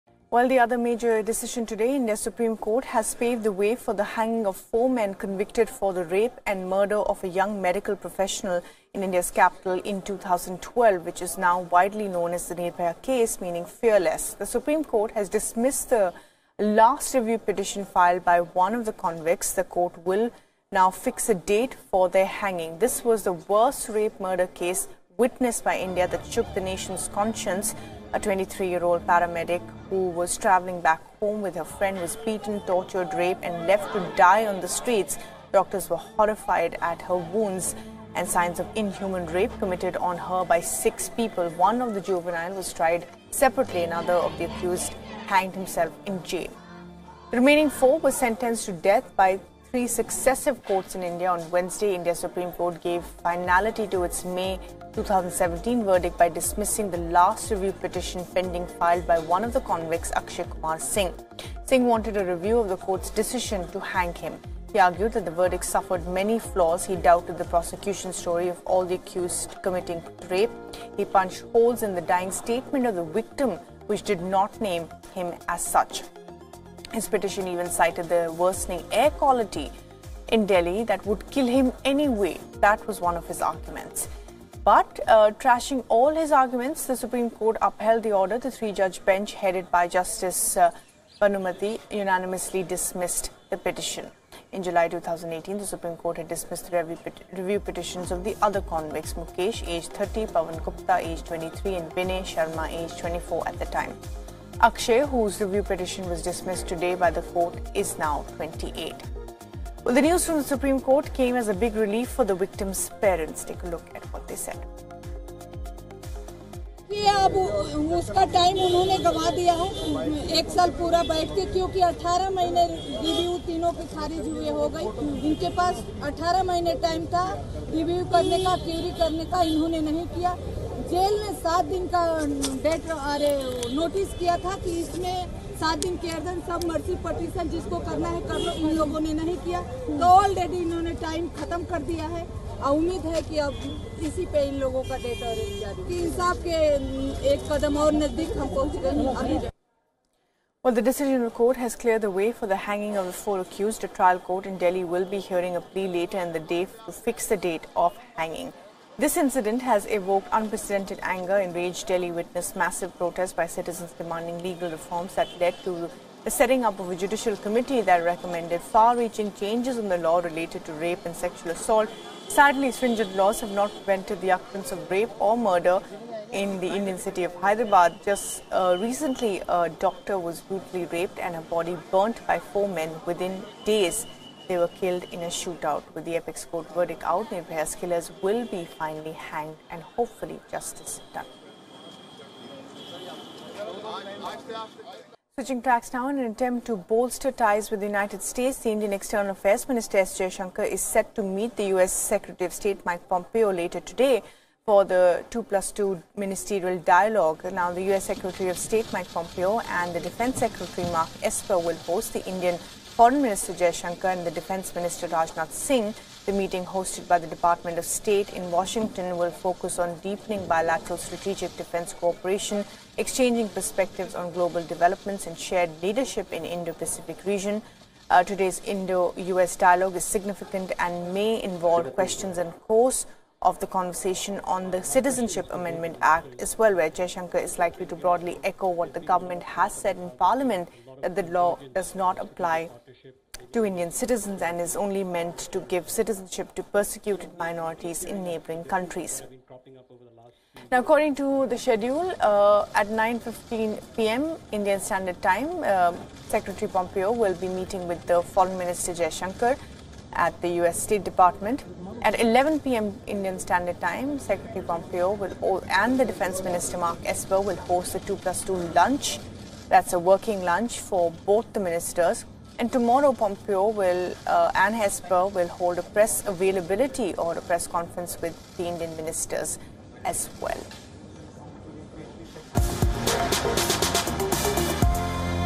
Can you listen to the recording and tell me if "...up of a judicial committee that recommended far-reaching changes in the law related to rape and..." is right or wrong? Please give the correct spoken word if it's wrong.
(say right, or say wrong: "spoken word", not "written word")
right.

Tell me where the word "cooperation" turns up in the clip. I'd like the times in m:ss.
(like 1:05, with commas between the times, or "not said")
3:41.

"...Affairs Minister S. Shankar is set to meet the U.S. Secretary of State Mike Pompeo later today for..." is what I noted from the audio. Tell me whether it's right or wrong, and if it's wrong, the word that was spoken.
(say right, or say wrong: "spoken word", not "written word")
right.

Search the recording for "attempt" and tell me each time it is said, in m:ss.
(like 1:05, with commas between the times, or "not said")
3:16.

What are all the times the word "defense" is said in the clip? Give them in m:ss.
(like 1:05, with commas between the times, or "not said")
3:30, 3:34, 3:41, 4:26.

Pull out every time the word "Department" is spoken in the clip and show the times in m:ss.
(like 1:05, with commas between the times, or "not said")
3:37, 4:21.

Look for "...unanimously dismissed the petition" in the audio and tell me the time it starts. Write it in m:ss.
1:31.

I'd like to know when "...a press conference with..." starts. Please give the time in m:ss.
4:37.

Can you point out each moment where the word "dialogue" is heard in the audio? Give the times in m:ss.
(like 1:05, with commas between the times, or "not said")
3:26, 3:49.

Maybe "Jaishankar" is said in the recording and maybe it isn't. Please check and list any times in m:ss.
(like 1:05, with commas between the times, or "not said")
3:56, 4:18.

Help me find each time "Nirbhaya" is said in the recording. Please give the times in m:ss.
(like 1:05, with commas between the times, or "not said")
0:12, 3:07.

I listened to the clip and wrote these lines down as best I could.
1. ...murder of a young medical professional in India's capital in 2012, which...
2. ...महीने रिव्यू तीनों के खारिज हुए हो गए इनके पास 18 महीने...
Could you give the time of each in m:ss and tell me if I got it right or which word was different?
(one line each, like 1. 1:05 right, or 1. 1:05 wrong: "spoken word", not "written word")
1. 0:06 right
2. 2:02 right.